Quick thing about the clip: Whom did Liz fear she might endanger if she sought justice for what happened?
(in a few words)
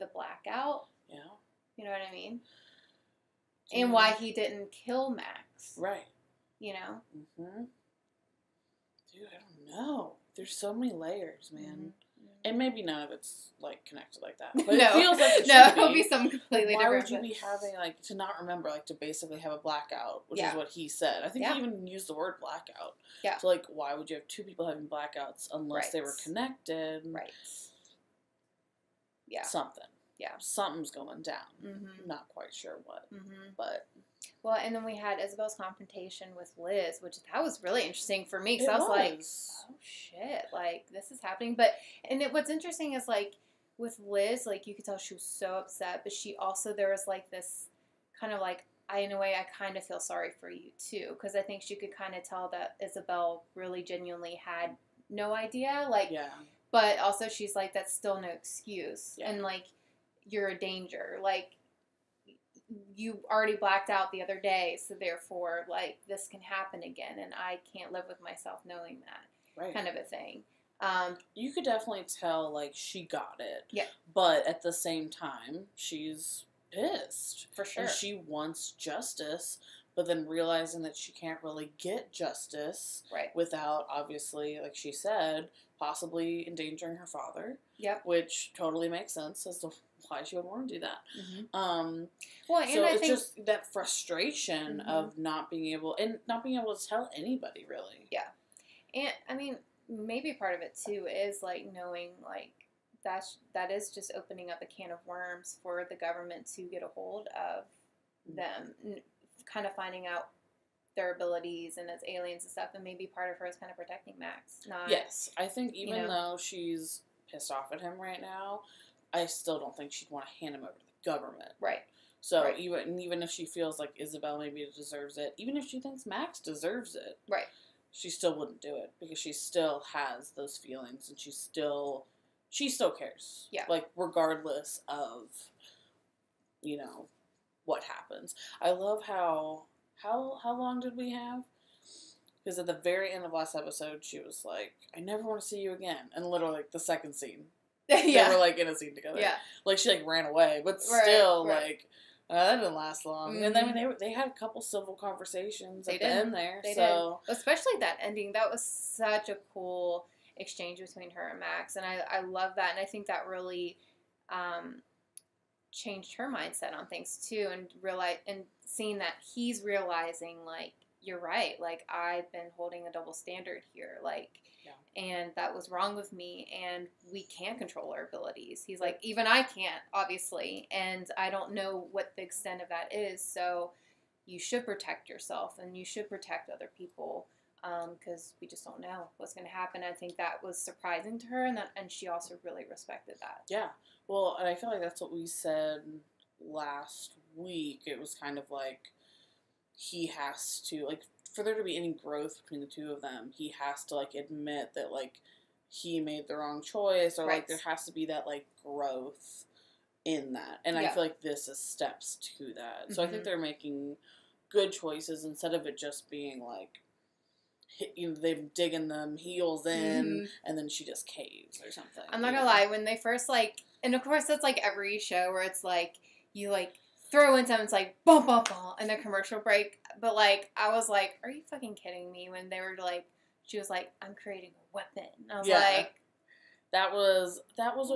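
Her father.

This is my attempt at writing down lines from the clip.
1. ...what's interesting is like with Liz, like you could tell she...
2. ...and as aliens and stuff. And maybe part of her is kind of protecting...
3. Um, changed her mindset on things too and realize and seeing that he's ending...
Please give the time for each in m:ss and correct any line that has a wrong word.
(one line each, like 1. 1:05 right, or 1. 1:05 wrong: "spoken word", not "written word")
1. 0:42 right
2. 1:51 right
3. 2:44 wrong: "realizing", not "ending".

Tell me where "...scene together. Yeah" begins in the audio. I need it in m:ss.
2:28.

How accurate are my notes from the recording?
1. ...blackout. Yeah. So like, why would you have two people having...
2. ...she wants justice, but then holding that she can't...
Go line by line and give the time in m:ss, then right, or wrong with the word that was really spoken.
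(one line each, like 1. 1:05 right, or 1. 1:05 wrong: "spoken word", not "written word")
1. 0:22 right
2. 1:17 wrong: "realizing", not "holding".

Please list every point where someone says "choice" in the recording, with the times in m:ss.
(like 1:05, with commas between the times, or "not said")
3:26, 3:34.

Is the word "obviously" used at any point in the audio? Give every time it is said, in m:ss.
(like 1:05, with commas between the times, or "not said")
1:23, 2:59.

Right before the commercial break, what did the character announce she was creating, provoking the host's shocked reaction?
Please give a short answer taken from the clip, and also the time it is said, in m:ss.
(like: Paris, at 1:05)
A weapon, at 3:54.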